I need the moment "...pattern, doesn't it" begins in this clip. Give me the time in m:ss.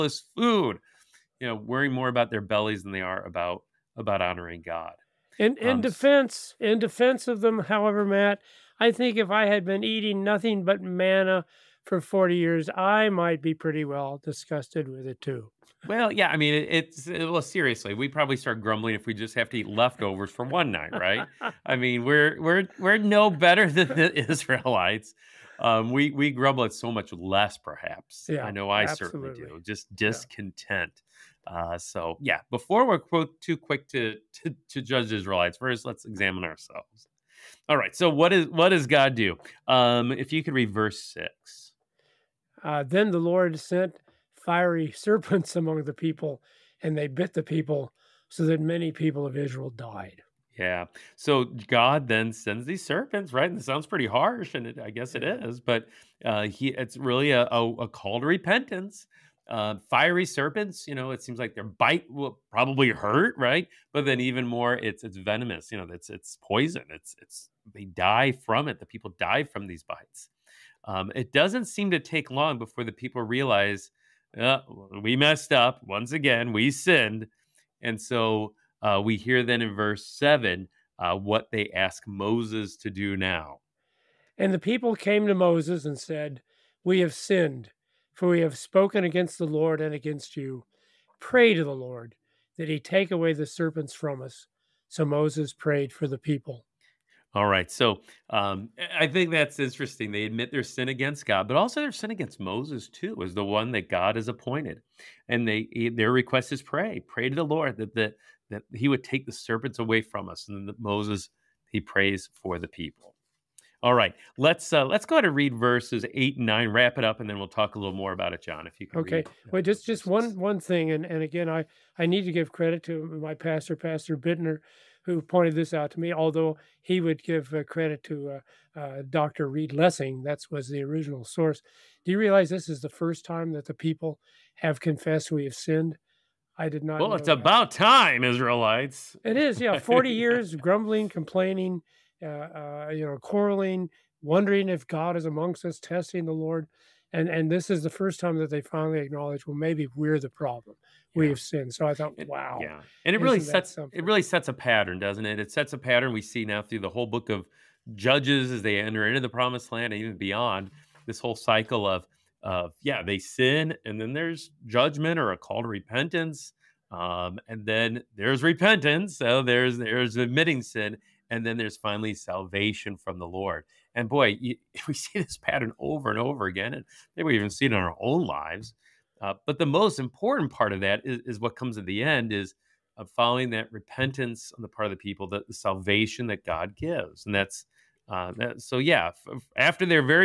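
2:34.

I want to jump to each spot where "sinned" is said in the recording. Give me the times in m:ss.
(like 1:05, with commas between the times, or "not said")
1:16, 1:27, 2:15, 2:31.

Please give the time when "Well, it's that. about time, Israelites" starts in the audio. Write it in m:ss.
2:17.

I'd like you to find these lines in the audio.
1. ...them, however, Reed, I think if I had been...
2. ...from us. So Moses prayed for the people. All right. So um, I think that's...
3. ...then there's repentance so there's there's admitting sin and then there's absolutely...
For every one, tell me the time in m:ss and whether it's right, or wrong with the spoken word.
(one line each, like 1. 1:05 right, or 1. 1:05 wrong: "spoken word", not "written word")
1. 0:07 wrong: "Matt", not "Reed"
2. 1:33 right
3. 2:47 wrong: "finally", not "absolutely".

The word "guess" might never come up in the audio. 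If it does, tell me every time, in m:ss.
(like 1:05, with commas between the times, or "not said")
0:54.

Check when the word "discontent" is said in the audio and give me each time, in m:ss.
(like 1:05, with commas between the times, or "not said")
0:29.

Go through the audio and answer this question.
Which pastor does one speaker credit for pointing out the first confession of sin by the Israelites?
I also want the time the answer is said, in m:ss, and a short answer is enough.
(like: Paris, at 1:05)
Pastor Bittner, at 2:03.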